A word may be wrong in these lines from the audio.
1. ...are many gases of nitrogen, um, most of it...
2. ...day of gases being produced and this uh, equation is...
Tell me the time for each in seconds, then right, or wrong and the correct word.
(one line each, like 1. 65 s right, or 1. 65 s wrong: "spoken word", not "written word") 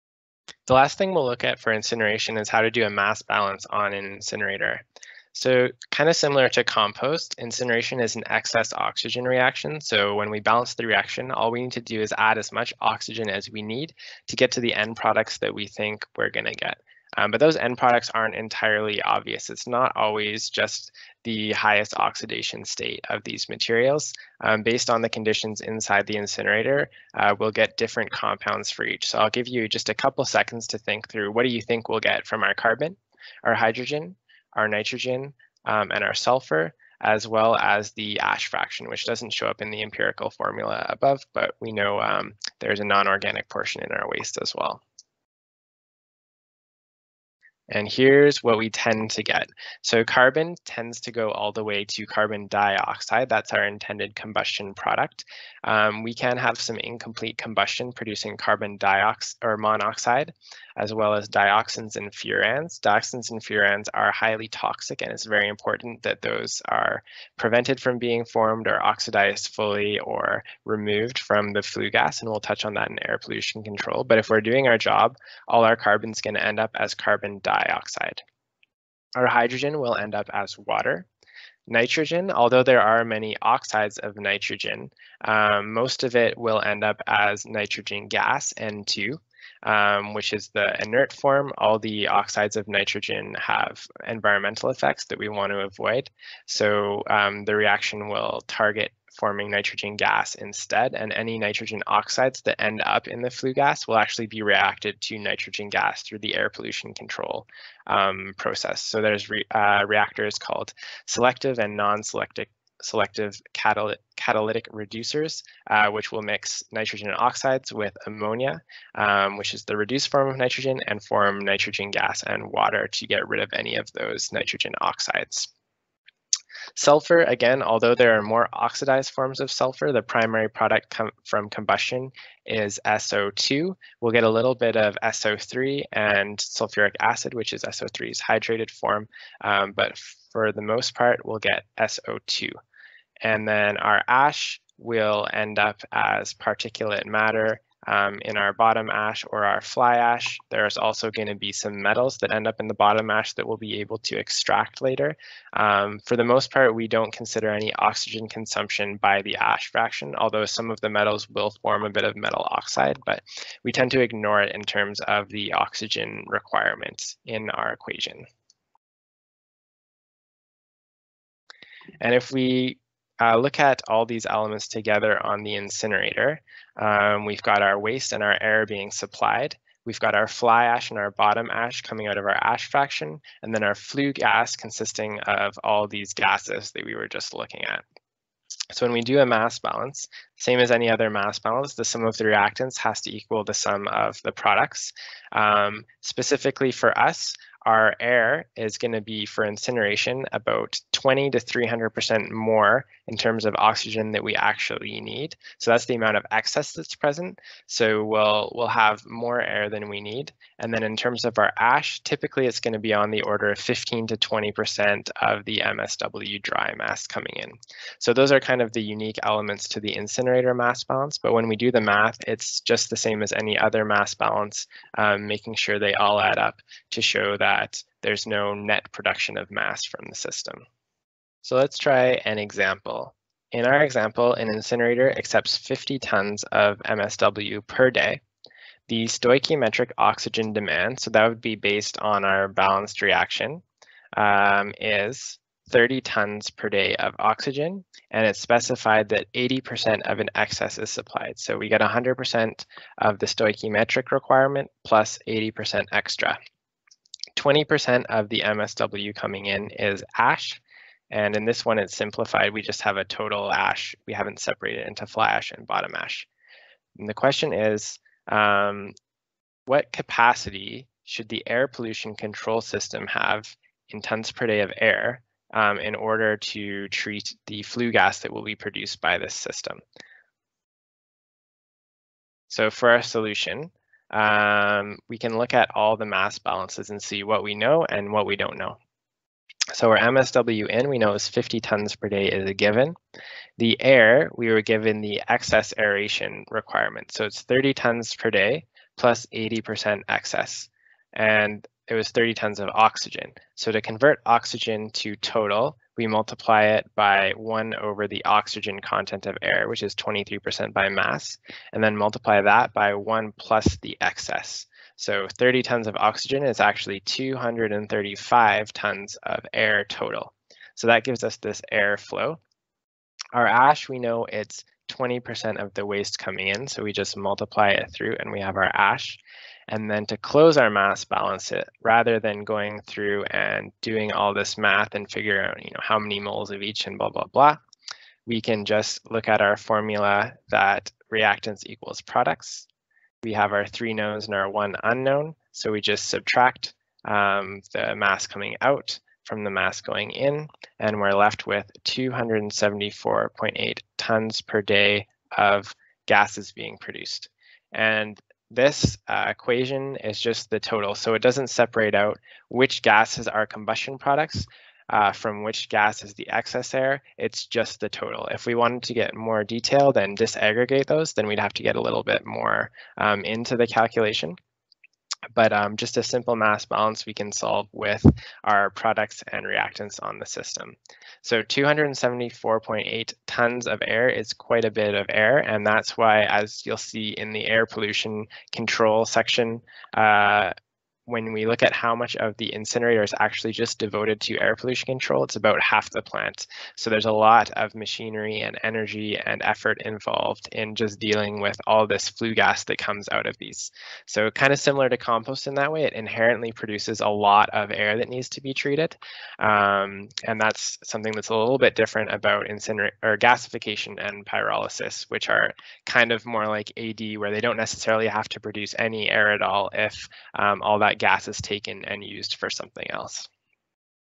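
1. 82 s wrong: "oxides", not "gases"
2. 354 s right.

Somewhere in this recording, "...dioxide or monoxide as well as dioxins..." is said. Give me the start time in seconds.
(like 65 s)
58 s.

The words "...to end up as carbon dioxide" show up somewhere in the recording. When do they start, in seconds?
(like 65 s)
76 s.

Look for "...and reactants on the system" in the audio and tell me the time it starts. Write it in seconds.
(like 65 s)
379 s.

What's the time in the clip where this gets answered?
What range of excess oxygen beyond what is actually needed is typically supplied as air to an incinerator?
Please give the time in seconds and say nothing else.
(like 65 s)
200 s.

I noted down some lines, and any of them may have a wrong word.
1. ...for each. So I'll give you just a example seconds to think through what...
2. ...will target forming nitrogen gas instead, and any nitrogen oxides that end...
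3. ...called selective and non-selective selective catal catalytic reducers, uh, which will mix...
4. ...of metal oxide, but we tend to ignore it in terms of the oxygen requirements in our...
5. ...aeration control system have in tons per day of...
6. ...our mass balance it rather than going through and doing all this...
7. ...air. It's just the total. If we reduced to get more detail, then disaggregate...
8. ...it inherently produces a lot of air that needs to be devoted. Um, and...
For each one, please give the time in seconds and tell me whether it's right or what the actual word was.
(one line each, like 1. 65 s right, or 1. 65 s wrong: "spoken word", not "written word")
1. 28 s wrong: "couple", not "example"
2. 98 s right
3. 110 s right
4. 162 s right
5. 271 s wrong: "pollution", not "aeration"
6. 330 s right
7. 366 s wrong: "wanted", not "reduced"
8. 405 s wrong: "treated", not "devoted".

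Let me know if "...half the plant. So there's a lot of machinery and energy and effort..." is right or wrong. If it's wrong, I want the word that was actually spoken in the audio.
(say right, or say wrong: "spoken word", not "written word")
right.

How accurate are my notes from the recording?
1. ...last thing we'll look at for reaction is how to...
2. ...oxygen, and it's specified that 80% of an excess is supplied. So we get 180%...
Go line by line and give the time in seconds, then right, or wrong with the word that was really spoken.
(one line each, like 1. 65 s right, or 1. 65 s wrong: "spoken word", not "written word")
1. 0 s wrong: "incineration", not "reaction"
2. 247 s wrong: "100", not "180".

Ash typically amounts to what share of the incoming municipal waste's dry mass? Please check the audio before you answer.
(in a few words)
15 to 20%.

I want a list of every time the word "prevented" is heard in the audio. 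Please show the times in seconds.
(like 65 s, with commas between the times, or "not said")
67 s.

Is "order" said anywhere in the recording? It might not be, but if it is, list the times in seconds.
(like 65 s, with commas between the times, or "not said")
213 s, 275 s.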